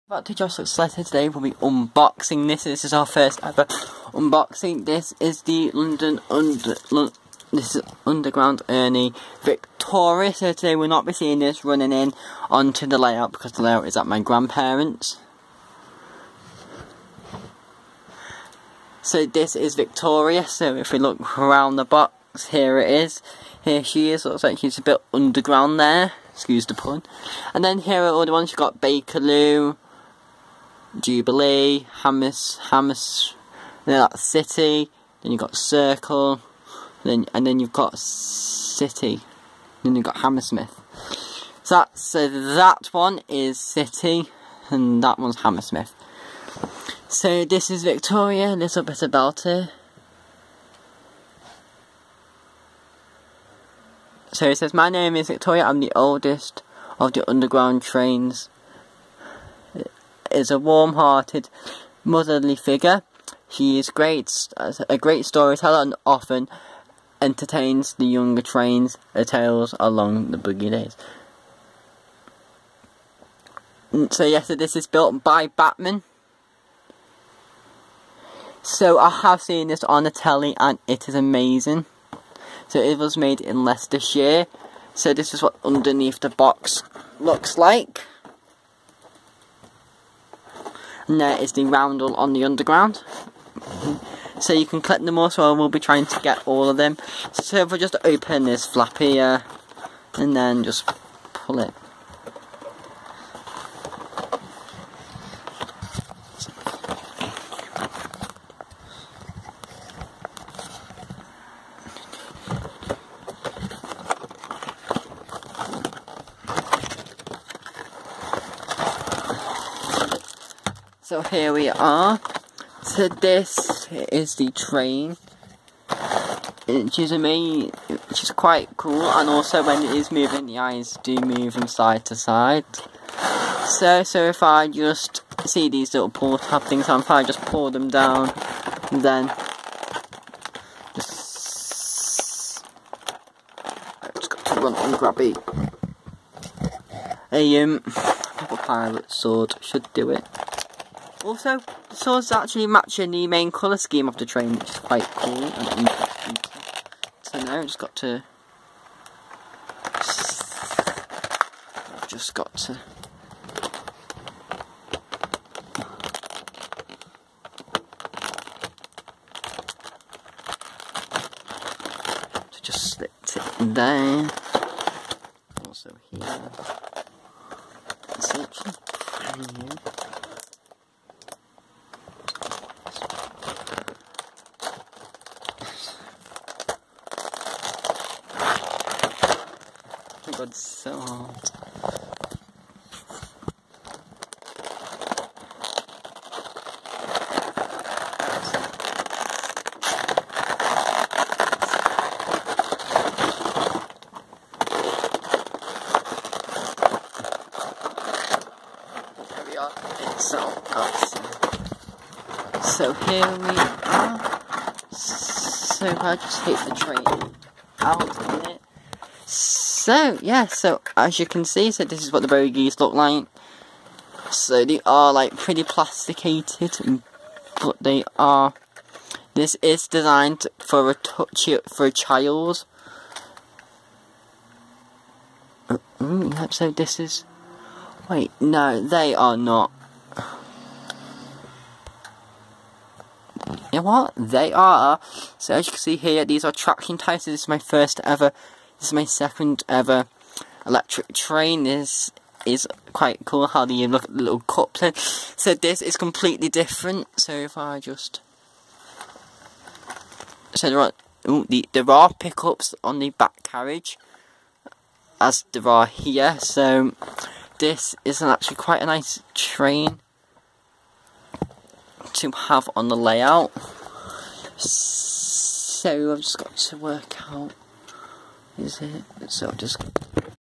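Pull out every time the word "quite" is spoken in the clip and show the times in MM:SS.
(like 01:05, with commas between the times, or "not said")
02:08, 02:34, 04:12, 04:28.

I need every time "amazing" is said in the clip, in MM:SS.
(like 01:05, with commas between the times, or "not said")
01:21, 02:07.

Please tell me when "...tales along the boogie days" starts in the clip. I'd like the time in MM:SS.
01:09.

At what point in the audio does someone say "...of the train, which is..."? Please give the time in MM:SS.
02:34.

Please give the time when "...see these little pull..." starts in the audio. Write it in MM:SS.
02:15.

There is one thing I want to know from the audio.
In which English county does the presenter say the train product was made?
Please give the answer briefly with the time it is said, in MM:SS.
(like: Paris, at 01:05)
Leicestershire, at 01:23.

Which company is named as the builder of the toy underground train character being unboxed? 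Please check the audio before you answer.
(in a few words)
Bachmann.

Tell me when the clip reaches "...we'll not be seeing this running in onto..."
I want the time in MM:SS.
00:10.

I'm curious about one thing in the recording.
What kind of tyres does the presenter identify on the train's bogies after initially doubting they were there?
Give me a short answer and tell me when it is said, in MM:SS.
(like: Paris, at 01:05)
Traction tires, at 04:06.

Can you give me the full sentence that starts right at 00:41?
So that, so that one is City, and that one's Hammersmith.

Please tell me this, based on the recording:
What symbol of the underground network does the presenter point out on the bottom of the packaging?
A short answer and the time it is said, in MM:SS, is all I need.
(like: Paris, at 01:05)
The roundel, at 01:31.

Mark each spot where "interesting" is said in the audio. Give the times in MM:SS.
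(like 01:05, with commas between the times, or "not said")
02:35.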